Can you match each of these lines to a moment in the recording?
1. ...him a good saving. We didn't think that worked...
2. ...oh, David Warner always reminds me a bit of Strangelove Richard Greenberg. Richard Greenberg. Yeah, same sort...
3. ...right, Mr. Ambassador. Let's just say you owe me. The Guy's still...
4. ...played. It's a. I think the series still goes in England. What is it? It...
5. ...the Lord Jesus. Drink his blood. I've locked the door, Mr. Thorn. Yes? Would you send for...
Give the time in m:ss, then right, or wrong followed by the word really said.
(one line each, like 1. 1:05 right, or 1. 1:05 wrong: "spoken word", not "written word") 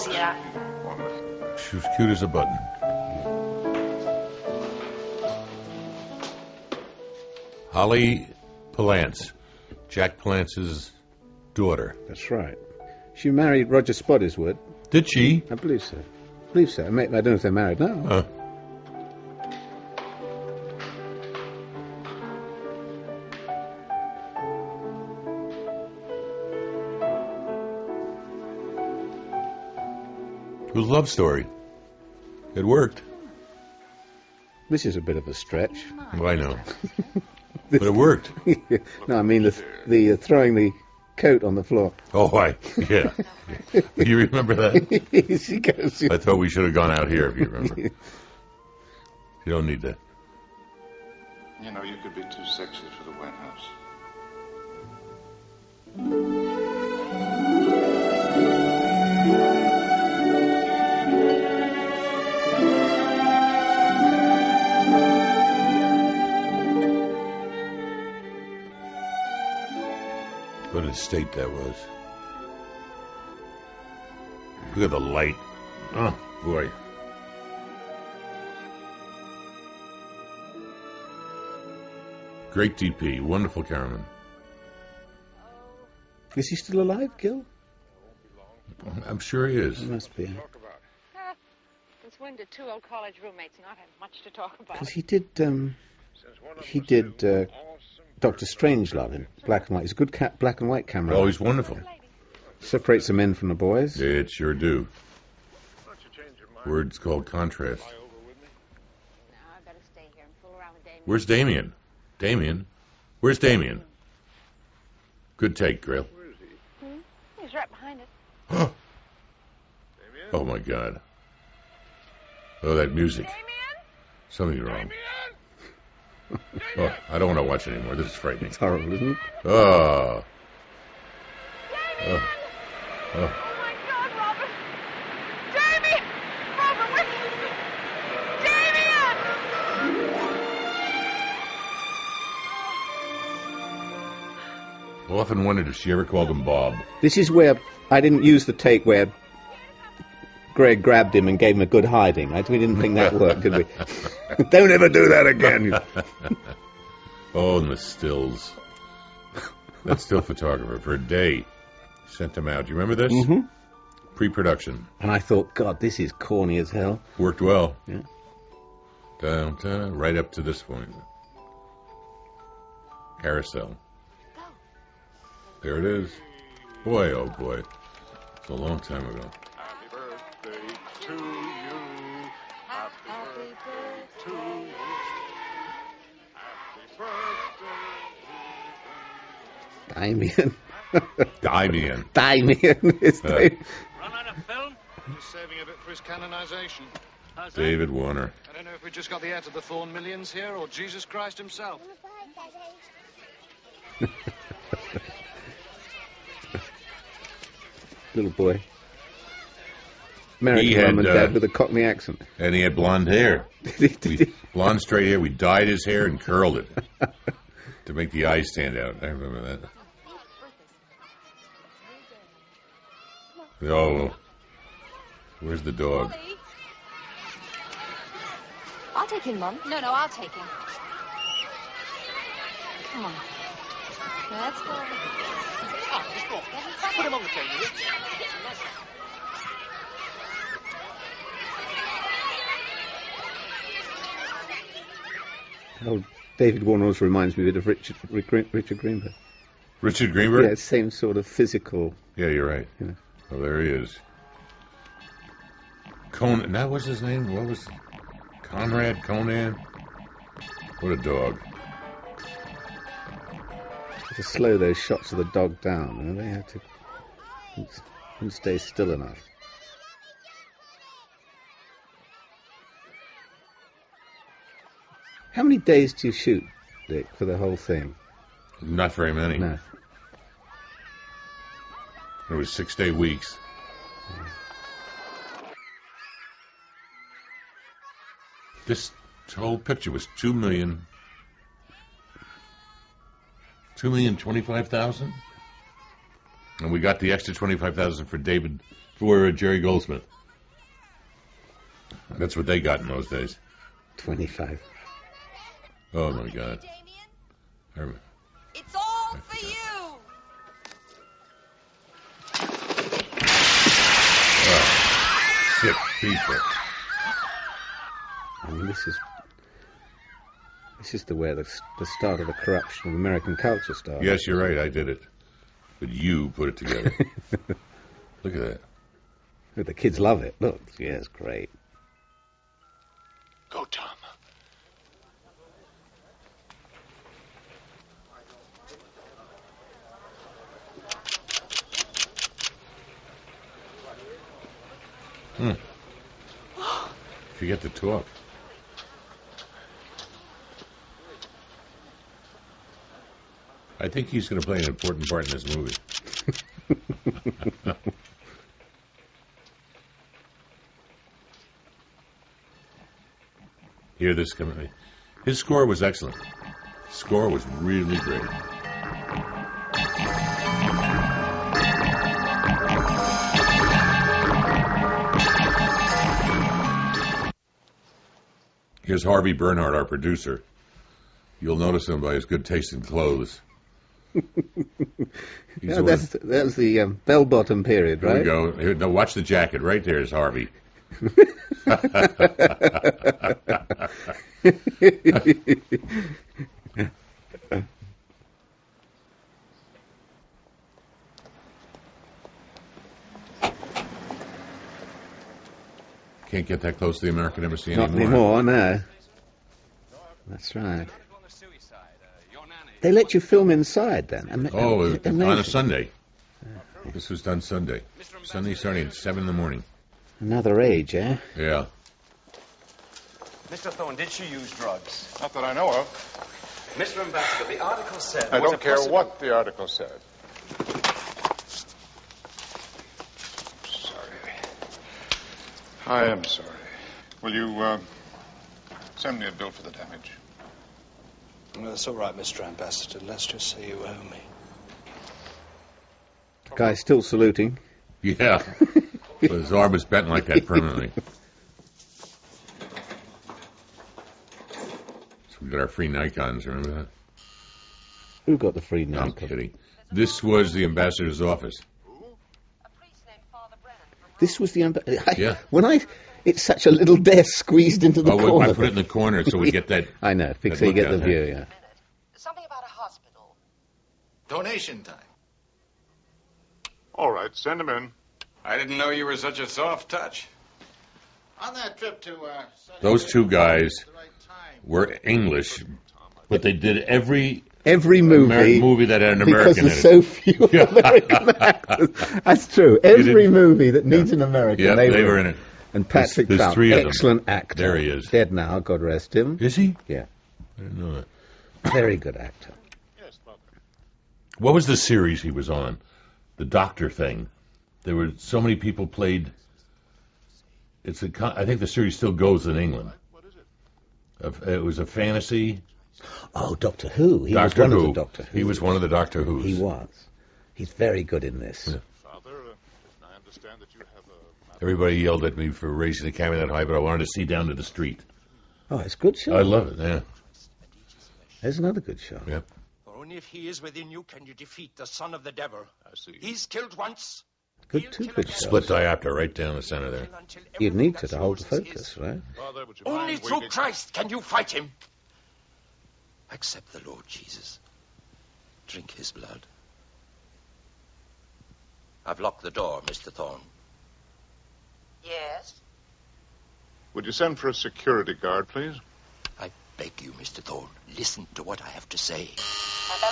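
1. 2:31 wrong: "hiding", not "saving"
2. 4:05 wrong: "Richard", not "Strangelove"
3. 7:21 right
4. 8:28 right
5. 9:06 right.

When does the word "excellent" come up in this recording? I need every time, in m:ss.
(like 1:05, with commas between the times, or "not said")
6:05, 8:16.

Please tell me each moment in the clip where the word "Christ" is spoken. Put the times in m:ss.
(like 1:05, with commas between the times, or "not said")
3:21, 9:03.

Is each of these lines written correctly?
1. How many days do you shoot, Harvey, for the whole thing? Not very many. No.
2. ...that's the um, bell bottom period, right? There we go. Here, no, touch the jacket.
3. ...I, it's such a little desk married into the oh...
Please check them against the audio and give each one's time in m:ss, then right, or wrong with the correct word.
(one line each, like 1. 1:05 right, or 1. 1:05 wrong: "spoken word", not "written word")
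1. 4:35 wrong: "Dick", not "Harvey"
2. 6:26 wrong: "watch", not "touch"
3. 7:45 wrong: "squeezed", not "married".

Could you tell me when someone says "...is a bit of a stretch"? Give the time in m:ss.
0:34.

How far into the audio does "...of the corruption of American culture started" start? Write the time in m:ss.
5:22.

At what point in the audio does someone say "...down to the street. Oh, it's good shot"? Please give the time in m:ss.
8:47.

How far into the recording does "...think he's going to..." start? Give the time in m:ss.
5:53.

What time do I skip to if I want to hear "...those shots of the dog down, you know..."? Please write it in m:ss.
4:24.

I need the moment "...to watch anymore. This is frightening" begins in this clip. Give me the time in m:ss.
2:07.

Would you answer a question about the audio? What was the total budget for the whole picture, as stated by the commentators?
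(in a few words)
2,025,000.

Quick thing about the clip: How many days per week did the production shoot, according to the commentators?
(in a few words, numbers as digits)
6.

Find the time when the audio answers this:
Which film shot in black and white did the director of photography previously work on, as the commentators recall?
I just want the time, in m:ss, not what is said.
1:38.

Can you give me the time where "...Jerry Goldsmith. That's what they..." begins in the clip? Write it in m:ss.
4:59.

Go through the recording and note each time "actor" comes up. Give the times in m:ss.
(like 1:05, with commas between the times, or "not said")
8:11, 8:17, 8:22.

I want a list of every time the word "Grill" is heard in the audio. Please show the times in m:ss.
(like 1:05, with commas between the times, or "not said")
1:55.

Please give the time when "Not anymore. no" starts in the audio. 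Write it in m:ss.
6:47.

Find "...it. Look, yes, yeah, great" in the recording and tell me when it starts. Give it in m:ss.
5:30.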